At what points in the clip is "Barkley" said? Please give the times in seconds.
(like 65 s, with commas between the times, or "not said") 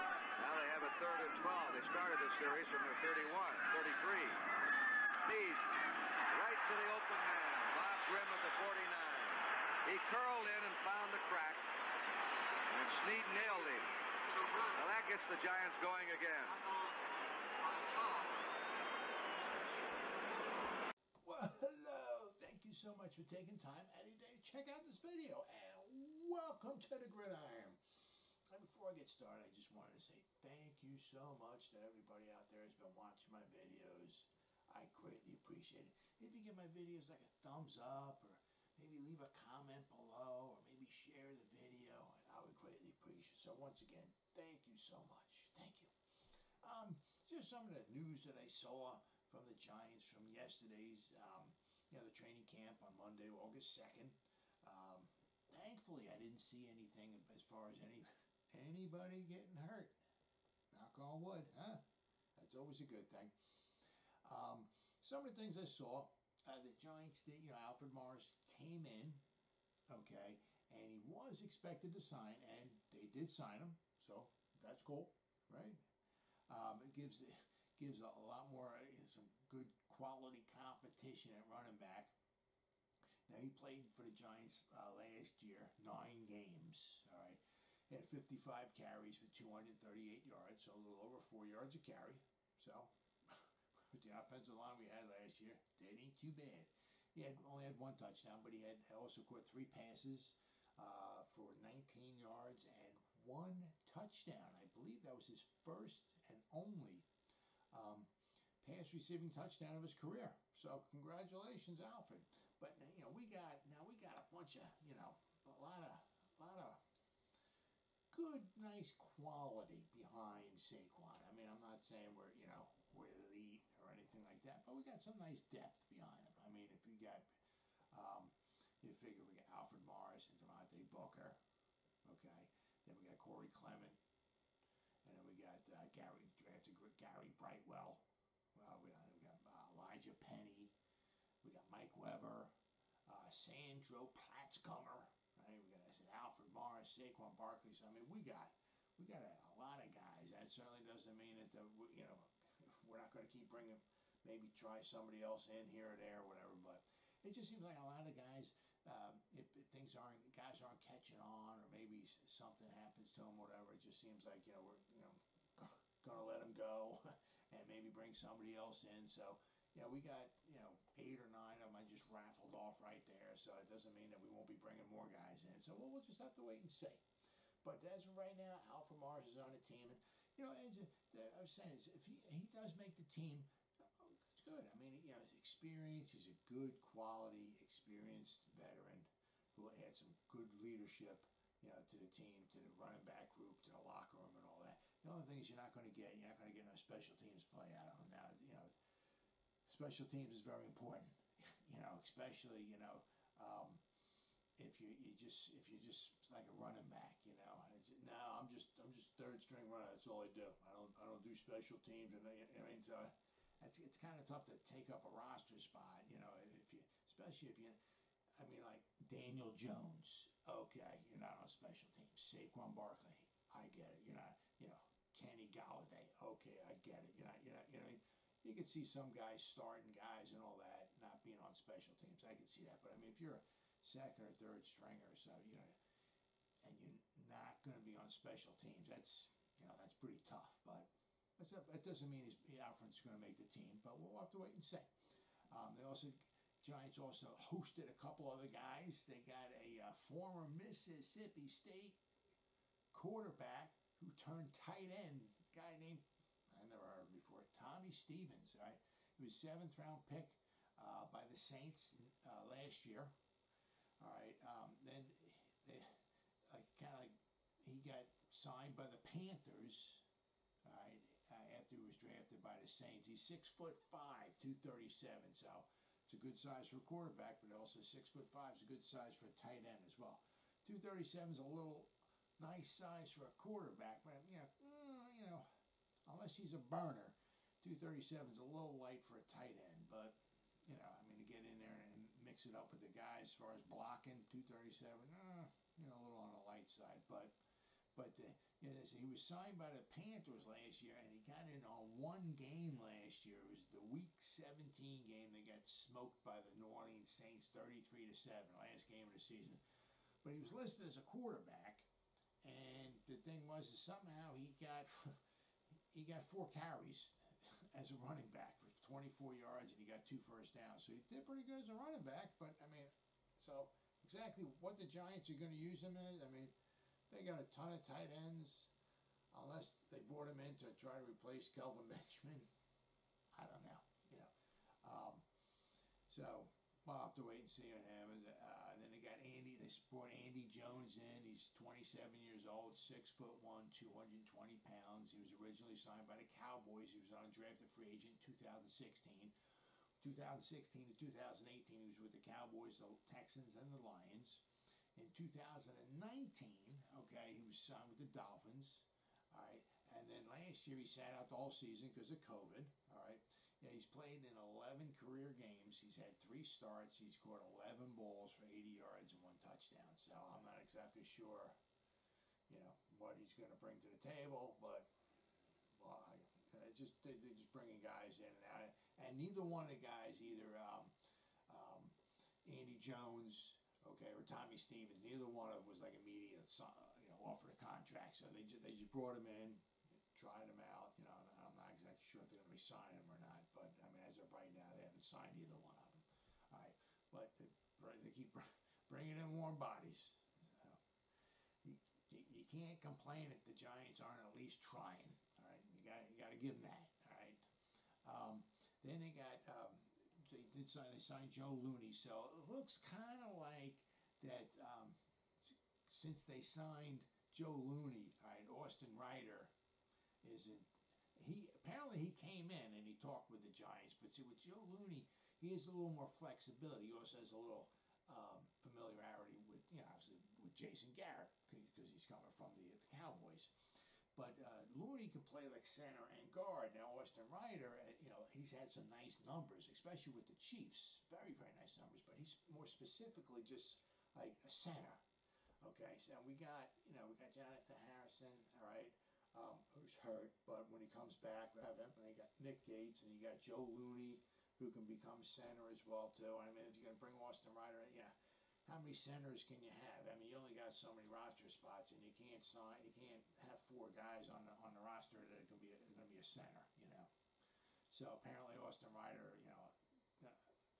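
147 s, 222 s.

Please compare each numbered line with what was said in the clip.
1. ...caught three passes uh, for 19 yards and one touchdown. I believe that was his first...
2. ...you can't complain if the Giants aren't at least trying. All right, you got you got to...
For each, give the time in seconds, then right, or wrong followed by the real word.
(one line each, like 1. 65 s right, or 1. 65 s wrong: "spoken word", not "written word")
1. 99 s right
2. 402 s right.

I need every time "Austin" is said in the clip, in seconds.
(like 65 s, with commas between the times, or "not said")
418 s, 436 s, 457 s, 468 s.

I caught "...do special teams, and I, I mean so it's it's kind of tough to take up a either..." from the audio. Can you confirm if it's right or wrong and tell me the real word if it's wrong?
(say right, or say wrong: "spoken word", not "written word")
wrong: "roster", not "either".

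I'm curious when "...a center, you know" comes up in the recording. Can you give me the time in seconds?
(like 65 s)
466 s.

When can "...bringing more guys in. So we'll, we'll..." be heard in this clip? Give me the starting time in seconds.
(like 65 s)
174 s.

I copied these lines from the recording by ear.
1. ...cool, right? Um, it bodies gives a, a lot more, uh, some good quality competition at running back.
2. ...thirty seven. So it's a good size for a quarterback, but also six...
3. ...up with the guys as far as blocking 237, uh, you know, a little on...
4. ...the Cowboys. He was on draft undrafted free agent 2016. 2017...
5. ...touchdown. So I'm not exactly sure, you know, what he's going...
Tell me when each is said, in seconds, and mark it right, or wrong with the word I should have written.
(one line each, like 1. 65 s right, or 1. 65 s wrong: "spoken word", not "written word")
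1. 74 s wrong: "gives", not "bodies"
2. 274 s right
3. 292 s right
4. 346 s wrong: "2016", not "2017"
5. 369 s right.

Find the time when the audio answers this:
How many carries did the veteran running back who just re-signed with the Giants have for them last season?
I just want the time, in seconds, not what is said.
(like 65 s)
88 s.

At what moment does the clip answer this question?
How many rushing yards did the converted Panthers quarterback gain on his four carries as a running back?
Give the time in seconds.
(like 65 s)
318 s.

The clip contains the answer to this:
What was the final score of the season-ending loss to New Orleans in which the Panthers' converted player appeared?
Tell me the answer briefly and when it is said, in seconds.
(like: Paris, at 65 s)
33 to 7, at 307 s.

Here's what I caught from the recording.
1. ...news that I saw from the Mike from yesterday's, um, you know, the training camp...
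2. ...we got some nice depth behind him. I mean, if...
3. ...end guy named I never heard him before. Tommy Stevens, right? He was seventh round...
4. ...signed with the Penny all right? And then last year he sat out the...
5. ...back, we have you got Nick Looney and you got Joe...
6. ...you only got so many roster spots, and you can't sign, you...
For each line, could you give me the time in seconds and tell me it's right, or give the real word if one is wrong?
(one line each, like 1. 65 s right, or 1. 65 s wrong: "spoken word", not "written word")
1. 47 s wrong: "Giants", not "Mike"
2. 124 s right
3. 254 s right
4. 357 s wrong: "Dolphins", not "Penny"
5. 451 s wrong: "Gates", not "Looney"
6. 460 s right.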